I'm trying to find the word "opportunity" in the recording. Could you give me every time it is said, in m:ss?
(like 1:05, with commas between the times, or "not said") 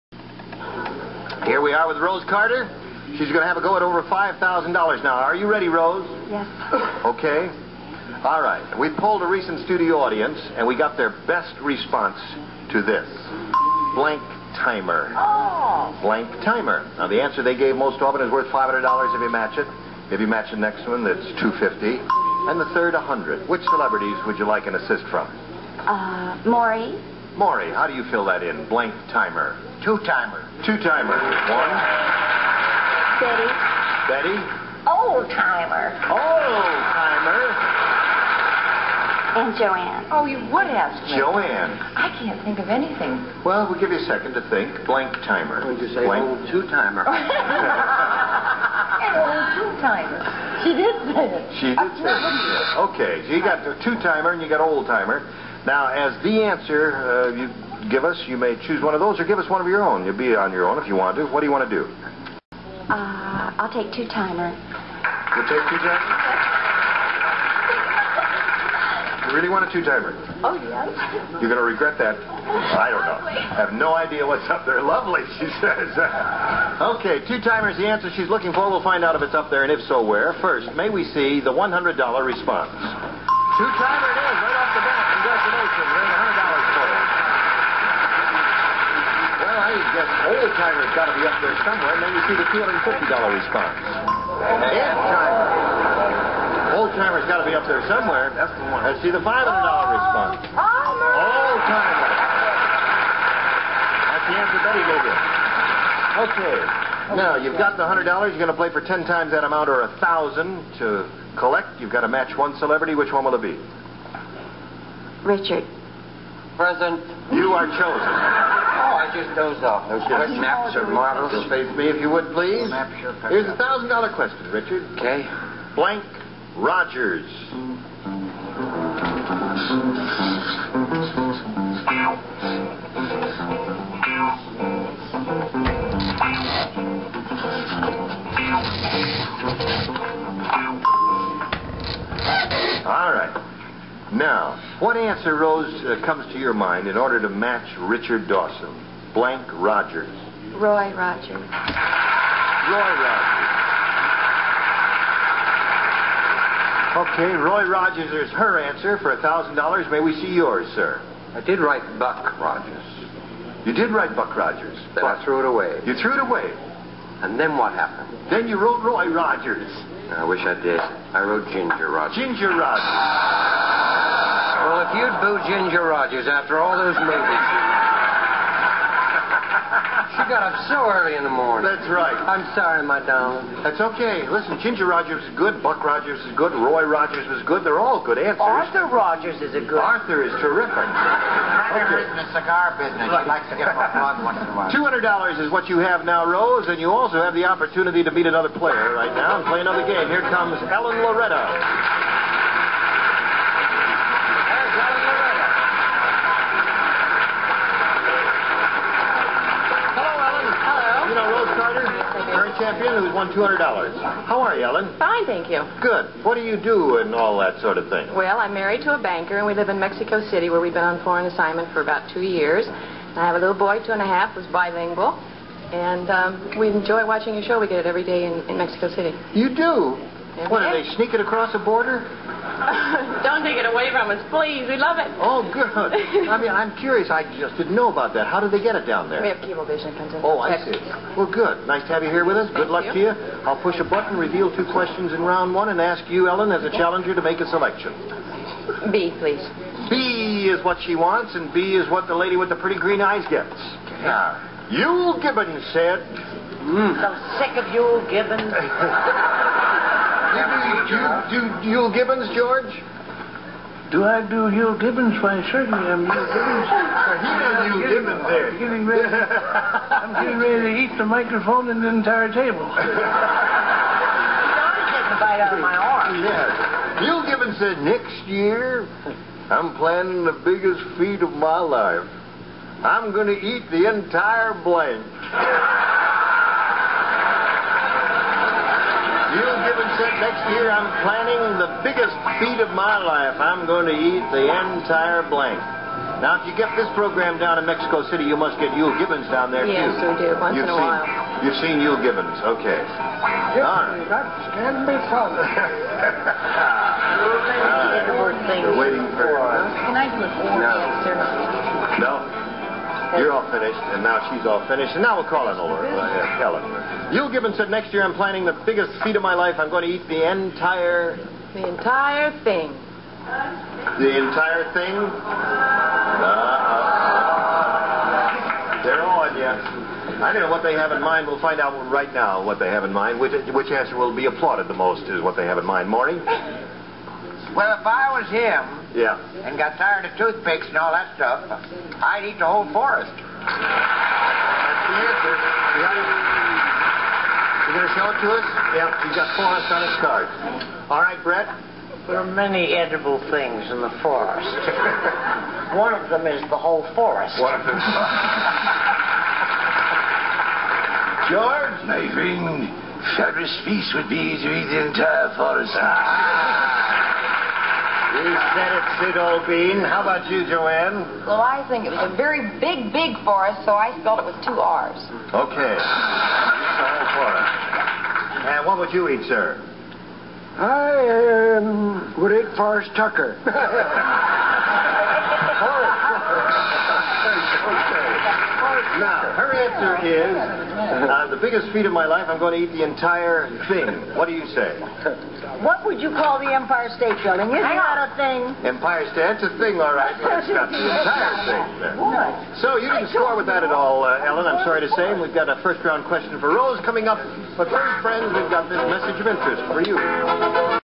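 3:17.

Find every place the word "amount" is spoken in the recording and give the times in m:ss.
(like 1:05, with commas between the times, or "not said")
1:49.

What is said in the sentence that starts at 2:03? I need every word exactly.
Here's a thousand dollar question, Richard.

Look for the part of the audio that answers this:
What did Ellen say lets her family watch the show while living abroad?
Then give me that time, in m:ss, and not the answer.
3:59.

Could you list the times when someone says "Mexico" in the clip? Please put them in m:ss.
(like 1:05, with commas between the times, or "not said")
3:39, 3:48, 4:57.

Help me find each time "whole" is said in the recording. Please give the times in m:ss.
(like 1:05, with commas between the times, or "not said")
5:42, 5:56.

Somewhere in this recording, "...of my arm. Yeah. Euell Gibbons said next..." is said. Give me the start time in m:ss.
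4:35.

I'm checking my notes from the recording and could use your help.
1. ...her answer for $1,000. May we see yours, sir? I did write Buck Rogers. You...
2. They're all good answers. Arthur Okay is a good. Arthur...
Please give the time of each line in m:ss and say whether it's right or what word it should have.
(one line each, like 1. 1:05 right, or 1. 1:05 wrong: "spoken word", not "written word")
1. 2:38 right
2. 3:07 wrong: "Rogers", not "Okay".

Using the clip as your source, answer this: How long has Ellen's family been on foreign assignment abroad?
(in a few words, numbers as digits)
About 2 years.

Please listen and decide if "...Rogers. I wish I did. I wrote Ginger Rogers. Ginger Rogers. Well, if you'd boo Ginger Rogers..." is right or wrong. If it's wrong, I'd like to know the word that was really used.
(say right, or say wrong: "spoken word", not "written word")
right.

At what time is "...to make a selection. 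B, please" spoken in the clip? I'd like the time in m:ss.
4:07.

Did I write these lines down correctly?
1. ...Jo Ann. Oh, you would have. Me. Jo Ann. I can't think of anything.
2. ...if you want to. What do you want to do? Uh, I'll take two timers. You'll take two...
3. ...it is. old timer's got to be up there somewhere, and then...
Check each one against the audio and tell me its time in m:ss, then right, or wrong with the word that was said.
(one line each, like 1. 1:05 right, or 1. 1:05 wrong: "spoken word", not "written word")
1. 0:39 right
2. 1:00 right
3. 1:24 right.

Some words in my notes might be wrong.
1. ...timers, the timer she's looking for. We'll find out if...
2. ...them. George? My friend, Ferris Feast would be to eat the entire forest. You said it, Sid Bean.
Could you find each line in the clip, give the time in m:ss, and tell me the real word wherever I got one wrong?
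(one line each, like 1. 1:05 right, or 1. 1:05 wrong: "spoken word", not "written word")
1. 1:17 wrong: "answer", not "timer"
2. 5:57 right.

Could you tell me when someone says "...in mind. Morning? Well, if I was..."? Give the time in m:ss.
5:35.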